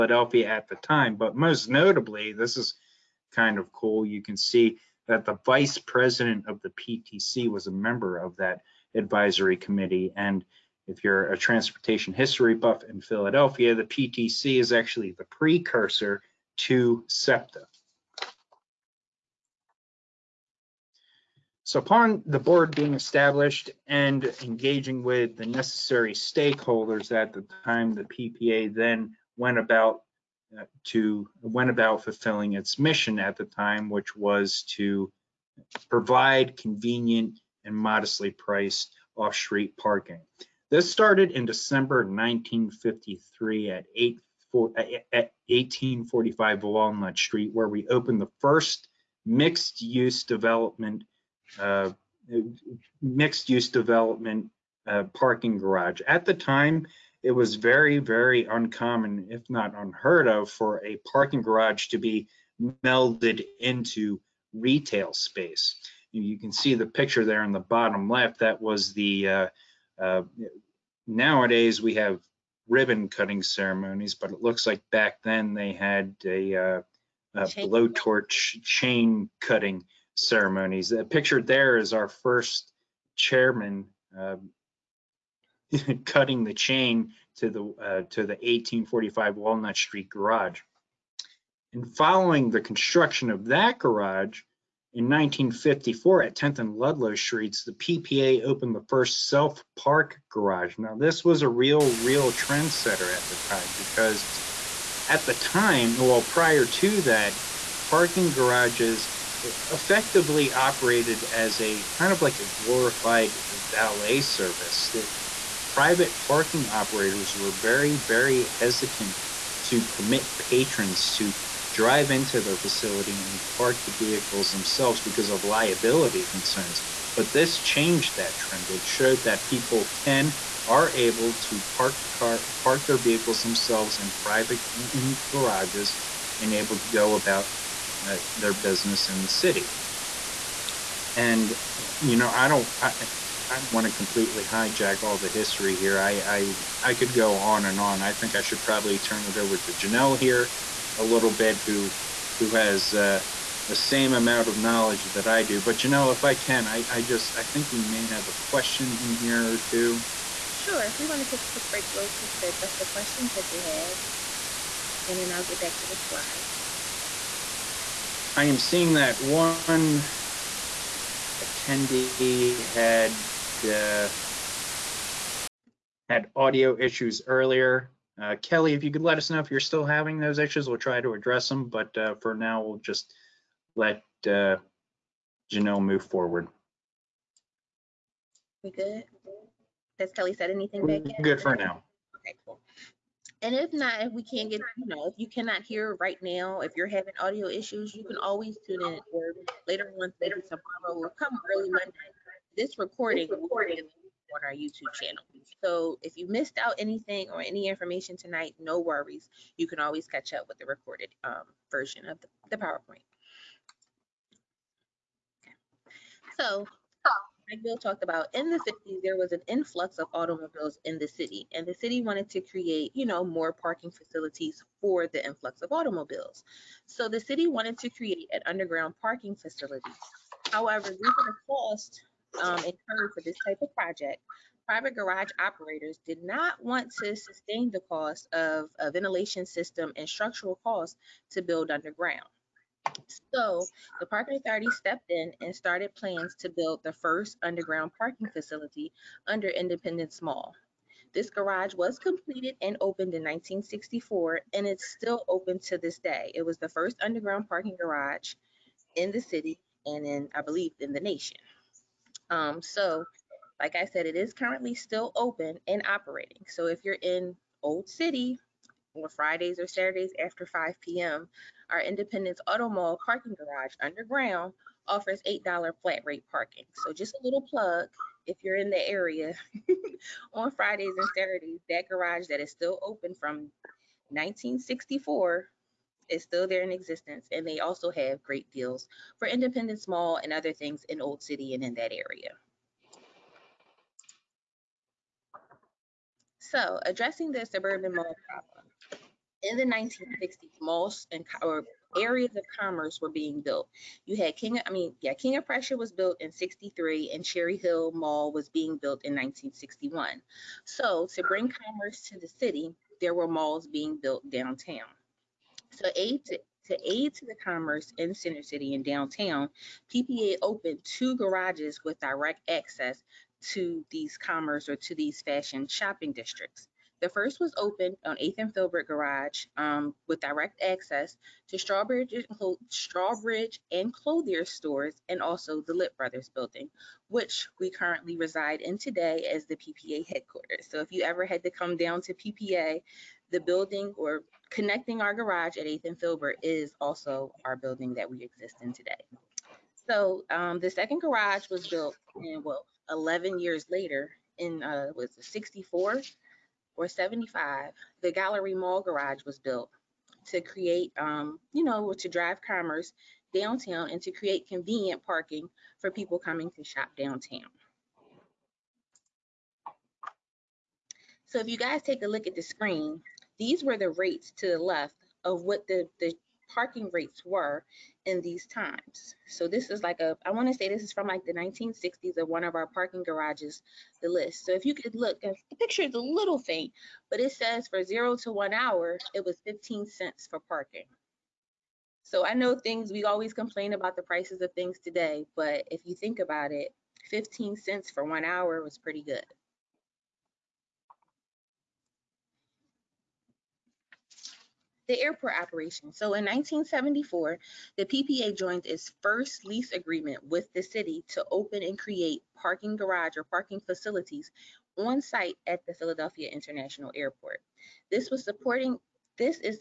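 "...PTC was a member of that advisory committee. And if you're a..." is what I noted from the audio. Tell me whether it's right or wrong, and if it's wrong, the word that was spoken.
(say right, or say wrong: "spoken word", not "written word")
right.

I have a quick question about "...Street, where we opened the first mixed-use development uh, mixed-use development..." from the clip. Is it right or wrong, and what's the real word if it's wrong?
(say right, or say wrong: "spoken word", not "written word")
right.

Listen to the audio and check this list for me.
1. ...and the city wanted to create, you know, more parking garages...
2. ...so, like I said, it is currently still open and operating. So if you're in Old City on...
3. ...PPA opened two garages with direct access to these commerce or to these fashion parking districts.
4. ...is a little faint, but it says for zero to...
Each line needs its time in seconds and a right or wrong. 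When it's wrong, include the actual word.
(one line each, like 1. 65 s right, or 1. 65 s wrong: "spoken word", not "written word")
1. 221 s wrong: "facilities", not "garages"
2. 262 s right
3. 319 s wrong: "shopping", not "parking"
4. 385 s right.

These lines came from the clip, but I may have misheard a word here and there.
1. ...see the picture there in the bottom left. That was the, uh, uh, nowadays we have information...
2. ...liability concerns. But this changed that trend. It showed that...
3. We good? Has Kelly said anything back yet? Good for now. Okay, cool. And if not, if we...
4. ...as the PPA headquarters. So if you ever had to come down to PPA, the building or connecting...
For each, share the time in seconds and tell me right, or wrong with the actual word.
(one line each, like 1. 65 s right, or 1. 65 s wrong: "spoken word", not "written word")
1. 66 s wrong: "ribbon", not "information"
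2. 125 s right
3. 188 s right
4. 339 s right.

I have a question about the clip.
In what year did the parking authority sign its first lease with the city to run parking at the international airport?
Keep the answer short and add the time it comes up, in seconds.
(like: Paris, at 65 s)
1974, at 406 s.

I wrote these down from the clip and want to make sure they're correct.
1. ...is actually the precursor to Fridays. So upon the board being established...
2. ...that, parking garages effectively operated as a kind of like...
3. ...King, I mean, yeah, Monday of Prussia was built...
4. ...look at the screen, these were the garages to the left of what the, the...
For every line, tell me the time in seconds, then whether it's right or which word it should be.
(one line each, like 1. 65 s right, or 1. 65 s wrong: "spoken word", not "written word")
1. 14 s wrong: "SEPTA", not "Fridays"
2. 107 s right
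3. 304 s wrong: "King", not "Monday"
4. 372 s wrong: "rates", not "garages".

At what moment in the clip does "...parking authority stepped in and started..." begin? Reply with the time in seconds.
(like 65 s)
244 s.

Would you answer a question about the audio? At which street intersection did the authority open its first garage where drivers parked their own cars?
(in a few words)
10th and Ludlow Streets.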